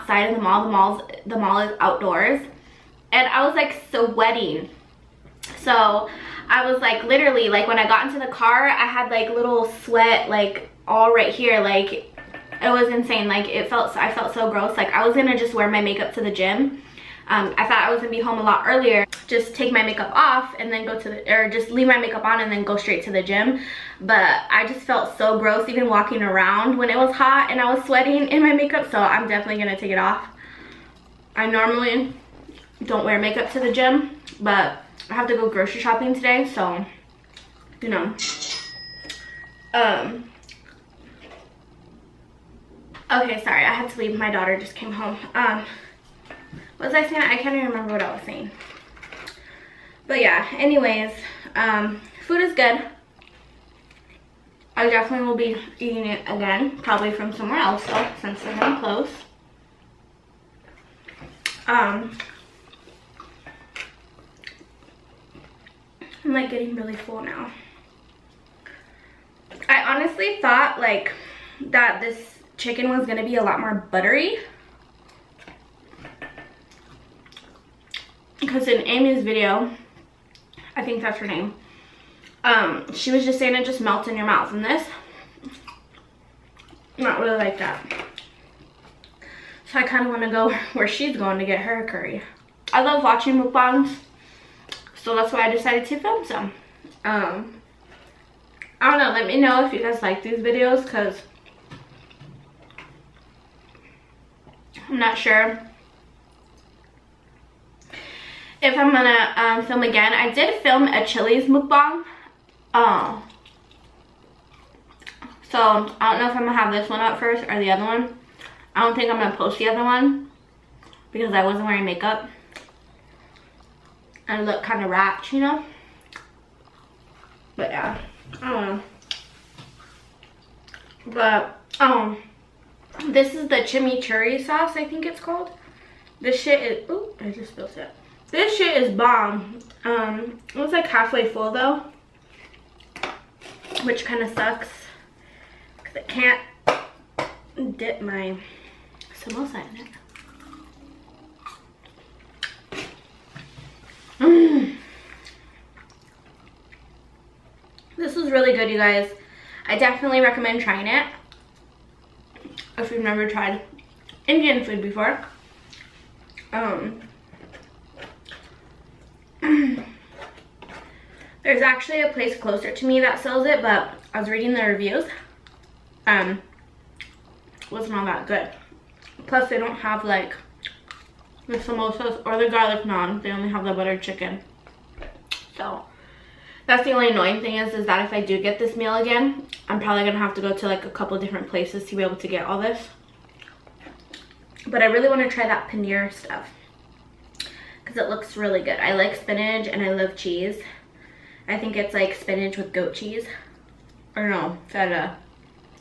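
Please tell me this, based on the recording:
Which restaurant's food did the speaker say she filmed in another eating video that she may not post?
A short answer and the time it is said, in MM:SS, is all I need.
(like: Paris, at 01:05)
Chili's, at 01:51.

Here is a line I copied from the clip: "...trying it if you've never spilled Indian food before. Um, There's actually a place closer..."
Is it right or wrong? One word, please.
wrong.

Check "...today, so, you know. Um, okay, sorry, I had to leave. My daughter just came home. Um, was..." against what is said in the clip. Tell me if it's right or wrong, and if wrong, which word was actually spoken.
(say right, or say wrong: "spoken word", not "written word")
right.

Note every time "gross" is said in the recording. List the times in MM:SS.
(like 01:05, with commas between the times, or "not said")
00:14, 00:25.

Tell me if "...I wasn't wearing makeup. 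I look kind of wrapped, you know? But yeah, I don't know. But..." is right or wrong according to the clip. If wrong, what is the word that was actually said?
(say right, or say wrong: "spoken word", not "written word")
right.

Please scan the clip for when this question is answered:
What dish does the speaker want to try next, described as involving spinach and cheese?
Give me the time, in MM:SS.
03:15.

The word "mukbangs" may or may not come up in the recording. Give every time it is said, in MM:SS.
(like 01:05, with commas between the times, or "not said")
01:33, 01:51.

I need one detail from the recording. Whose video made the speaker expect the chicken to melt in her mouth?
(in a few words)
Amy.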